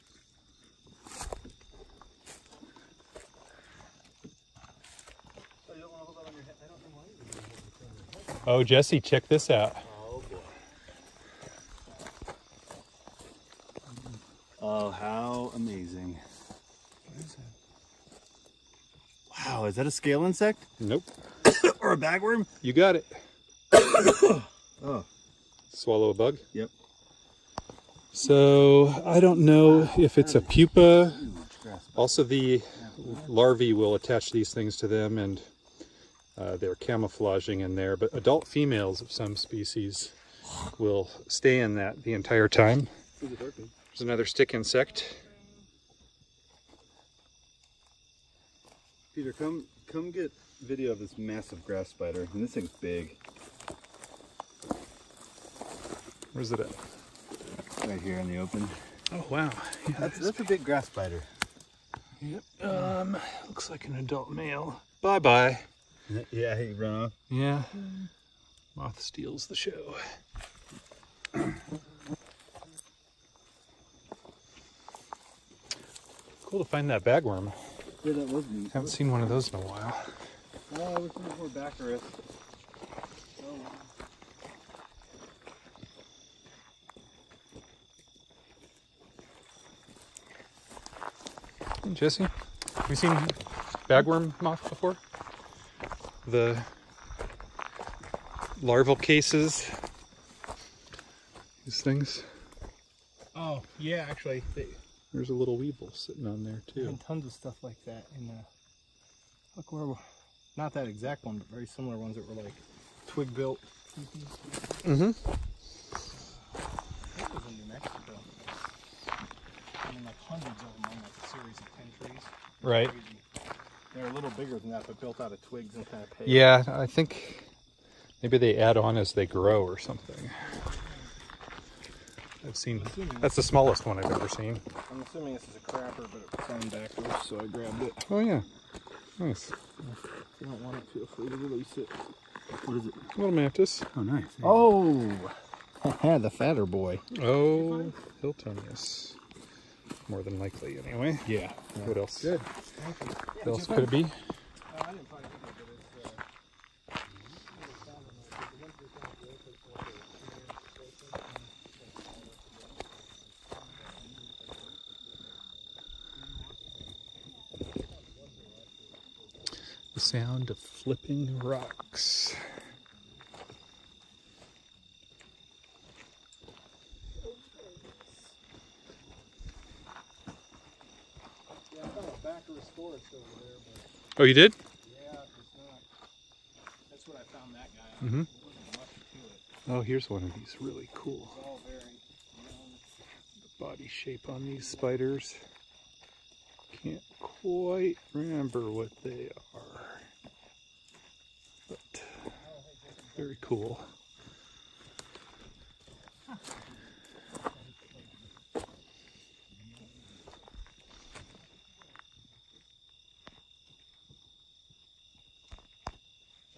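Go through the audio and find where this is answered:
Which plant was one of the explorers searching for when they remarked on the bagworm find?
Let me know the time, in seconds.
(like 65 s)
81 s.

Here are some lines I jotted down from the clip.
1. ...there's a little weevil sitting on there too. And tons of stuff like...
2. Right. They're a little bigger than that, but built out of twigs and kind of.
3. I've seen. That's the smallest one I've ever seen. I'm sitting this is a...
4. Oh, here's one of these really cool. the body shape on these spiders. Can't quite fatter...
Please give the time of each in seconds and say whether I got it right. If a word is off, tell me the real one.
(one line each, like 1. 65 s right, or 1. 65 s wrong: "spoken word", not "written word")
1. 105 s right
2. 122 s right
3. 132 s wrong: "assuming", not "sitting"
4. 189 s wrong: "remember", not "fatter".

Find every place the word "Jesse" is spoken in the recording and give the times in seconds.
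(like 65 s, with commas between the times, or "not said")
8 s, 91 s.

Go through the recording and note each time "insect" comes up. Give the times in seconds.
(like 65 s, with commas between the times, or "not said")
20 s, 44 s.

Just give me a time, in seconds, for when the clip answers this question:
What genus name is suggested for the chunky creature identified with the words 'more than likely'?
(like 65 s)
148 s.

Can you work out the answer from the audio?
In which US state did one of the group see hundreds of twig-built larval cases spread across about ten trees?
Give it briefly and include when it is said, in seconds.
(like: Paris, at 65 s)
New Mexico, at 117 s.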